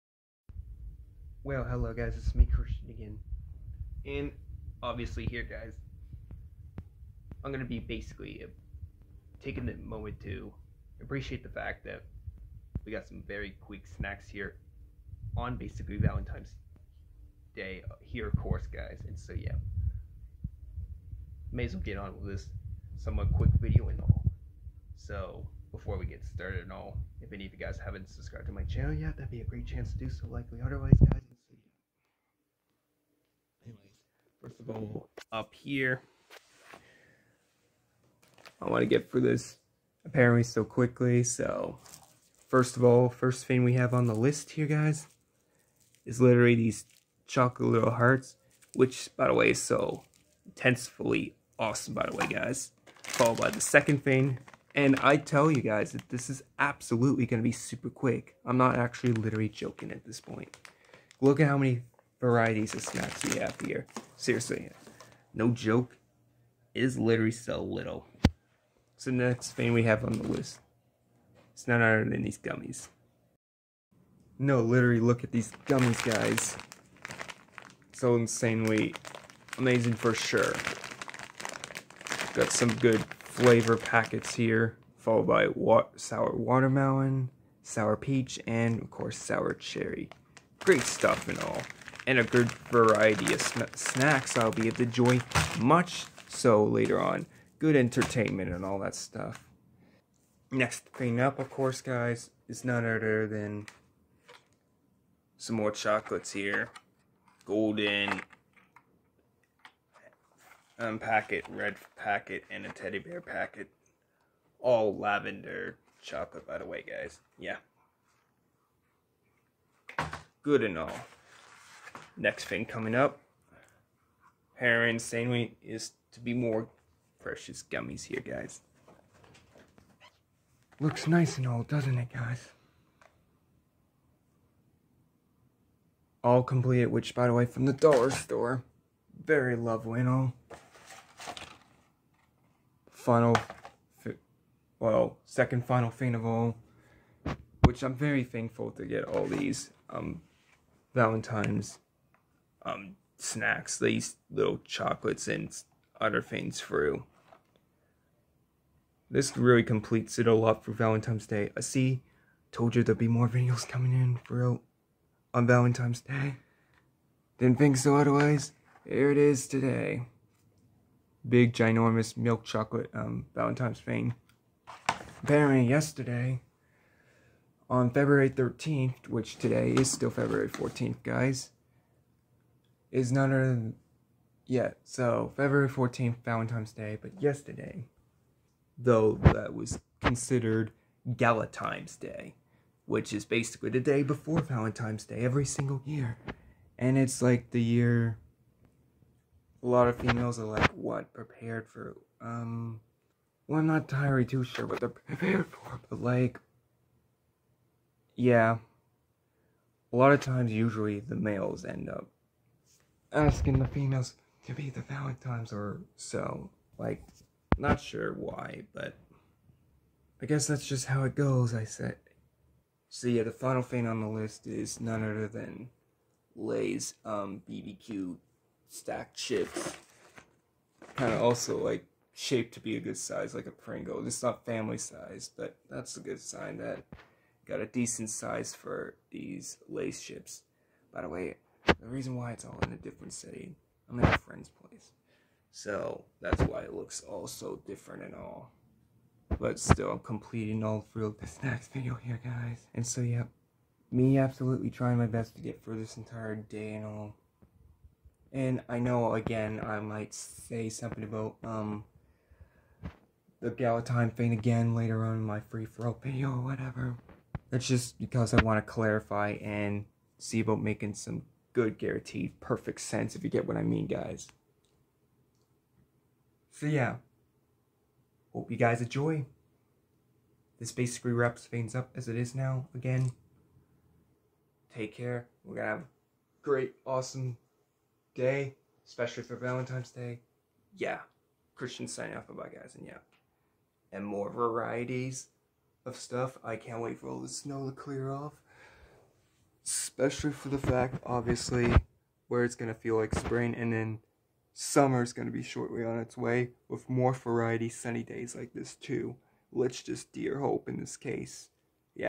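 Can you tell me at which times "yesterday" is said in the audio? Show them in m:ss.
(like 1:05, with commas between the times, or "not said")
2:55, 3:07.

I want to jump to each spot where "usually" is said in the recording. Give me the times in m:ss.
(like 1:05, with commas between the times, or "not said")
3:30.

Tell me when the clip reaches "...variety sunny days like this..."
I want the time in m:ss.
5:07.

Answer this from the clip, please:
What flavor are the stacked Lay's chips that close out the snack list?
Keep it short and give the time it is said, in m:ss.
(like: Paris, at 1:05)
BBQ, at 3:47.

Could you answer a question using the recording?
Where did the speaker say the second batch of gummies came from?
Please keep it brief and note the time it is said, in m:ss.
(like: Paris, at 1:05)
the dollar store, at 2:17.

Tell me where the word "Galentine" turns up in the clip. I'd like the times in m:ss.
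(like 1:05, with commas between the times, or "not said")
3:11, 4:23.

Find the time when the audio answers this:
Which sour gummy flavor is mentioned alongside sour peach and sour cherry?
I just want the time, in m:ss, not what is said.
1:25.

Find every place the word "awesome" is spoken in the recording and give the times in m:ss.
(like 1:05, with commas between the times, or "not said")
0:51, 4:46.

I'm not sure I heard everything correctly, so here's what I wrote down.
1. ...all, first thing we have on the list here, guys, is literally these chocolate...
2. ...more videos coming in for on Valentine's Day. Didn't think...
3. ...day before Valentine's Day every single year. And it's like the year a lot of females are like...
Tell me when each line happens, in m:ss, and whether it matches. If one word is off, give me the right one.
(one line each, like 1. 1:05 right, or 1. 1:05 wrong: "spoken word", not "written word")
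1. 0:42 right
2. 2:43 right
3. 3:13 right.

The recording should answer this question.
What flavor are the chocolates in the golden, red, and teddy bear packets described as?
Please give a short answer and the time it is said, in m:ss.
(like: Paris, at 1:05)
lavender, at 1:54.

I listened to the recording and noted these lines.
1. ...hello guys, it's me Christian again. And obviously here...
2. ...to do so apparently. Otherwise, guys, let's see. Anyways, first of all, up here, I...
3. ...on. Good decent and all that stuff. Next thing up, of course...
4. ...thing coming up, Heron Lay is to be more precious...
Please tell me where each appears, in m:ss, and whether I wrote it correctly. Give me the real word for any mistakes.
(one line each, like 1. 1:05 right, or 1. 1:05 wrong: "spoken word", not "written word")
1. 0:01 right
2. 0:29 wrong: "likely", not "apparently"
3. 1:37 wrong: "entertainment", not "decent"
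4. 2:02 wrong: "Sainway", not "Lay".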